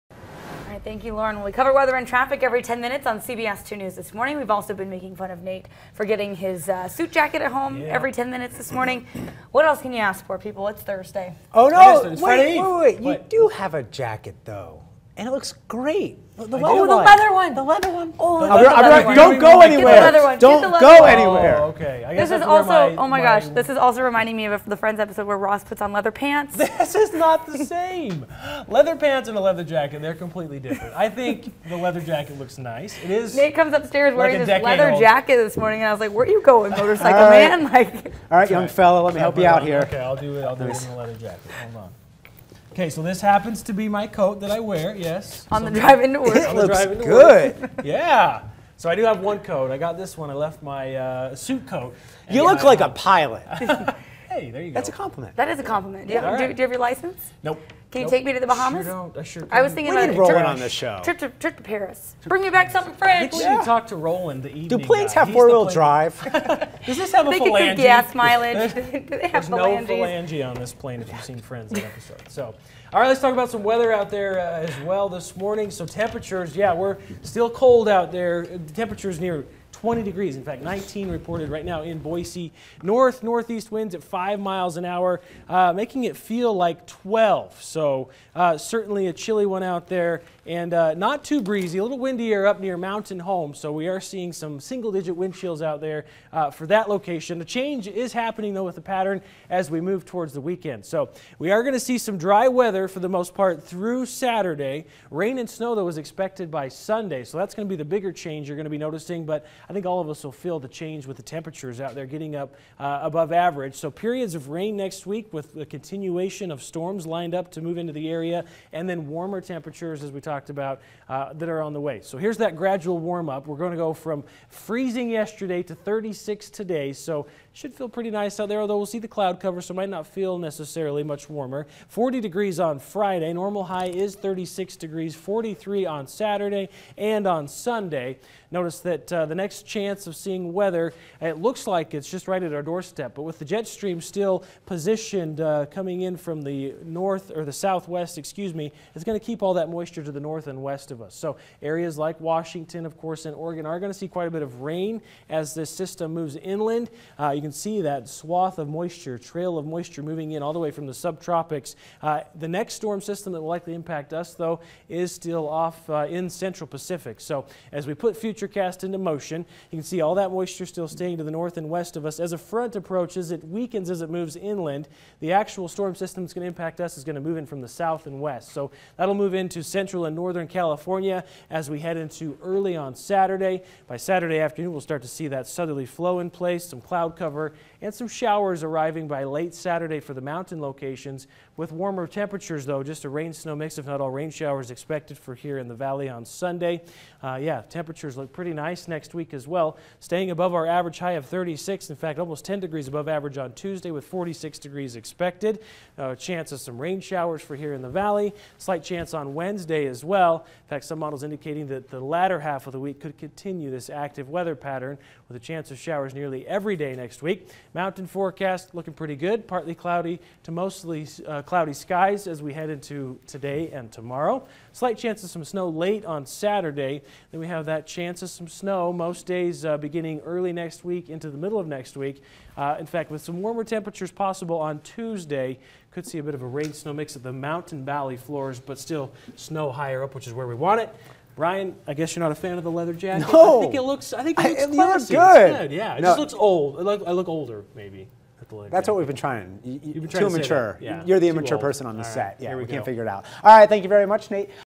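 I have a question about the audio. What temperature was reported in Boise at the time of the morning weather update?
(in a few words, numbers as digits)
19.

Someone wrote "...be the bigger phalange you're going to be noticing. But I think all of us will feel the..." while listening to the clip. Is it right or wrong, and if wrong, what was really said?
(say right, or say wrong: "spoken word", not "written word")
wrong: "change", not "phalange".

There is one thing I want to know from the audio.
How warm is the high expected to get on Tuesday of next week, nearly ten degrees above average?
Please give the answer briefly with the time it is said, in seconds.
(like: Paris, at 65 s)
46 degrees, at 204 s.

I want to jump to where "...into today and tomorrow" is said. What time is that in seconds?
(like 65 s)
222 s.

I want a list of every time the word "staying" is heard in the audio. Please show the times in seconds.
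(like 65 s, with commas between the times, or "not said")
170 s, 199 s.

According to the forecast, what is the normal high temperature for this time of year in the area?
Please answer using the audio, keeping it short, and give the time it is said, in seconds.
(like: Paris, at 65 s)
36 degrees, at 133 s.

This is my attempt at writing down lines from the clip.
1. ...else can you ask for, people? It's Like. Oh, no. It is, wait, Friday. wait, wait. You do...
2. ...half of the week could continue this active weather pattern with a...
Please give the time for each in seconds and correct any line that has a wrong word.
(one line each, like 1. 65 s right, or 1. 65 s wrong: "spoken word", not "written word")
1. 9 s wrong: "Thursday", not "Like"
2. 212 s right.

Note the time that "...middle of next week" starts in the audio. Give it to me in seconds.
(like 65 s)
231 s.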